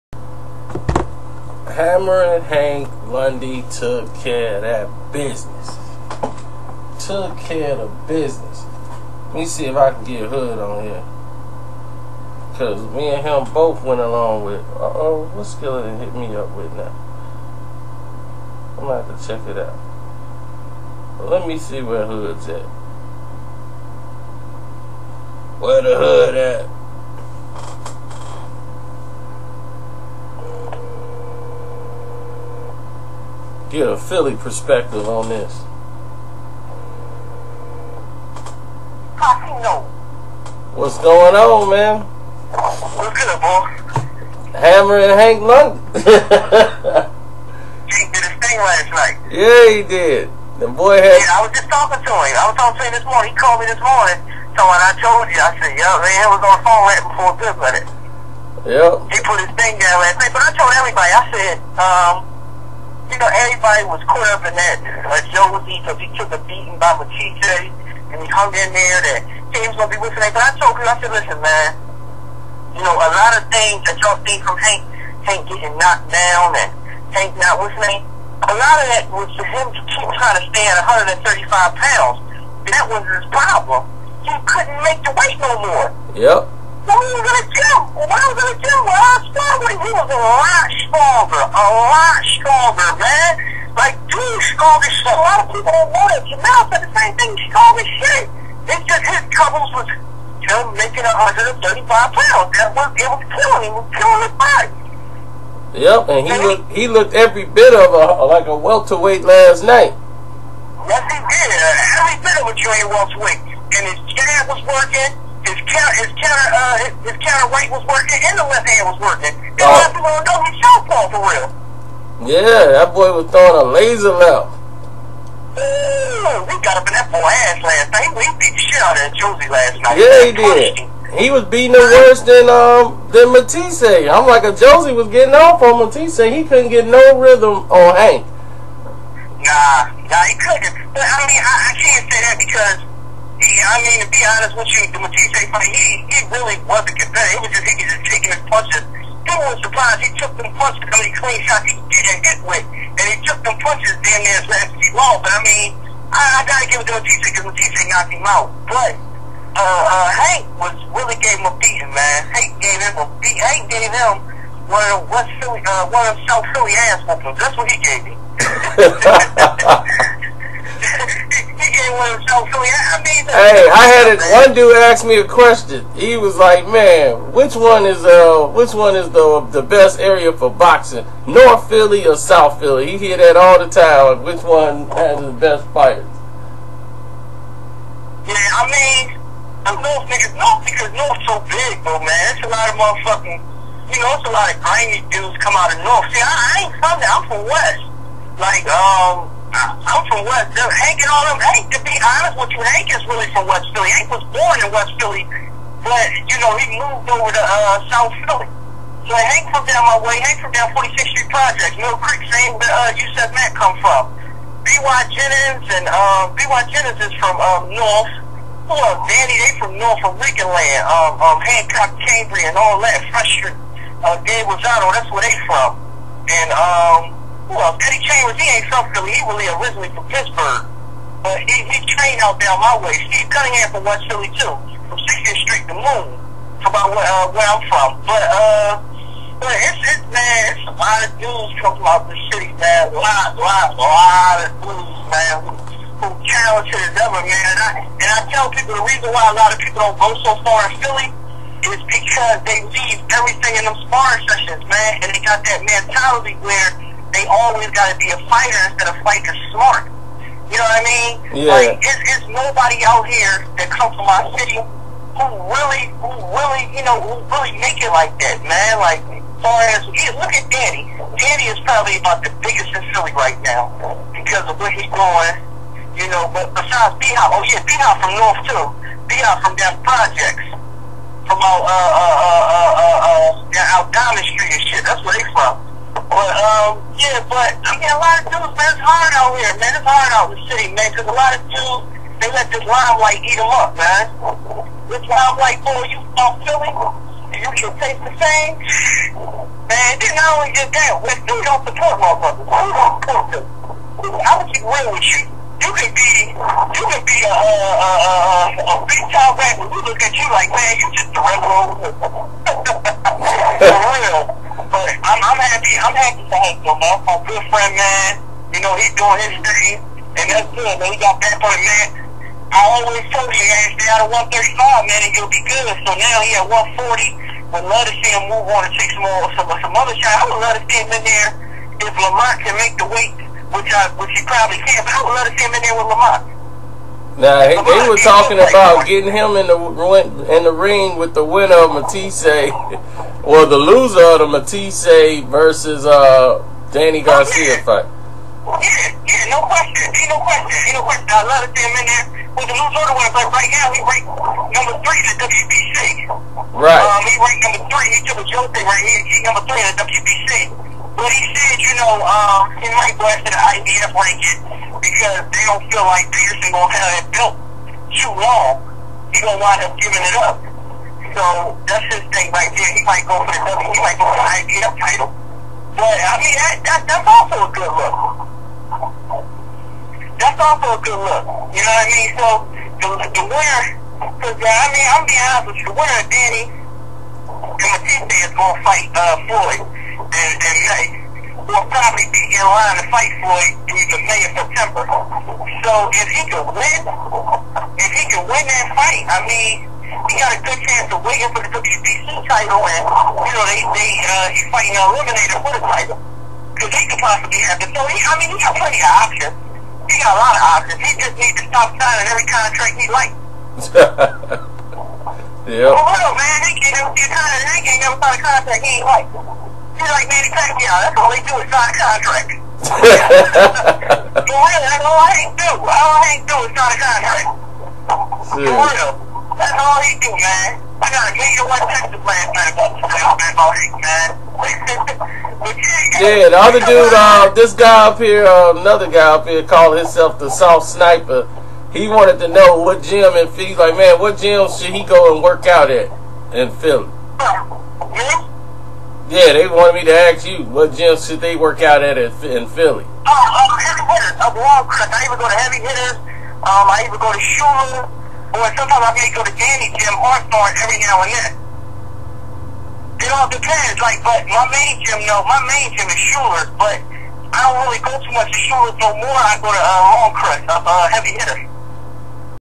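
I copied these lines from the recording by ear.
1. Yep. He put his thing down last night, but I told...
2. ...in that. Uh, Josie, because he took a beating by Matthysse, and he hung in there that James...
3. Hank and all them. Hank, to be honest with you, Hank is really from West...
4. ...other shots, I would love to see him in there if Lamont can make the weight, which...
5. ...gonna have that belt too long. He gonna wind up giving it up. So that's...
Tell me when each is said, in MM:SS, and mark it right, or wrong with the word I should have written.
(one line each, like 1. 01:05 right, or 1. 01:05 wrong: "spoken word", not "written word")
1. 00:58 right
2. 01:04 right
3. 03:20 right
4. 05:29 right
5. 06:06 right.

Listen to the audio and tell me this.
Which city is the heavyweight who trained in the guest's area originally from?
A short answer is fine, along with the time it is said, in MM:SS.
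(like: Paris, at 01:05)
Pittsburgh, at 03:50.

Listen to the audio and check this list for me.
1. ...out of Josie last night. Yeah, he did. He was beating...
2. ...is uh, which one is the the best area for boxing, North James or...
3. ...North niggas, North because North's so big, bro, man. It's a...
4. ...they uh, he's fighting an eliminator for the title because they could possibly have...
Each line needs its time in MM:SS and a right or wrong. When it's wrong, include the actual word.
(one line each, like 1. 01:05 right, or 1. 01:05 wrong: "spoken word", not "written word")
1. 02:08 right
2. 02:57 wrong: "Philly", not "James"
3. 03:09 right
4. 06:43 right.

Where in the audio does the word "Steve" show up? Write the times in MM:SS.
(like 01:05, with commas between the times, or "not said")
03:53.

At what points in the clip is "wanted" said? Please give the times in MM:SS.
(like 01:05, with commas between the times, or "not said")
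01:35, 07:21, 07:29.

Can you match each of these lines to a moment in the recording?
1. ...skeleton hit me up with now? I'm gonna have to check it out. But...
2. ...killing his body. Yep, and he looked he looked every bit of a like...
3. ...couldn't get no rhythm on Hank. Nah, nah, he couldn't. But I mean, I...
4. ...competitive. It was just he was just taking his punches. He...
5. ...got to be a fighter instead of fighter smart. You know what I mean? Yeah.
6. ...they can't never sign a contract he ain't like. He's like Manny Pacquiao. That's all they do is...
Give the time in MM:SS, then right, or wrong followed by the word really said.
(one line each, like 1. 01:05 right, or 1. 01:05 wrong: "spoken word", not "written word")
1. 00:15 right
2. 01:43 right
3. 02:16 right
4. 02:26 right
5. 04:17 right
6. 06:57 right.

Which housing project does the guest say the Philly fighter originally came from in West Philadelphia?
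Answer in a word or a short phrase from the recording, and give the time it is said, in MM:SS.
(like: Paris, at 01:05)
46th Street Projects, at 03:30.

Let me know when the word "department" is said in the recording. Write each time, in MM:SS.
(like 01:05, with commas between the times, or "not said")
not said.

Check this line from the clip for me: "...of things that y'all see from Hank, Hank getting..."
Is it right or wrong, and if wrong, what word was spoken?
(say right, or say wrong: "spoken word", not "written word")
right.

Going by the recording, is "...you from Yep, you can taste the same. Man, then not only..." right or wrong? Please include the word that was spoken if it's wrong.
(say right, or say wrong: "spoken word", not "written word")
wrong: "Philly", not "Yep".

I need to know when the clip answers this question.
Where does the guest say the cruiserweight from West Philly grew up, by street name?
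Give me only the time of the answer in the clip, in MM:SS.
03:54.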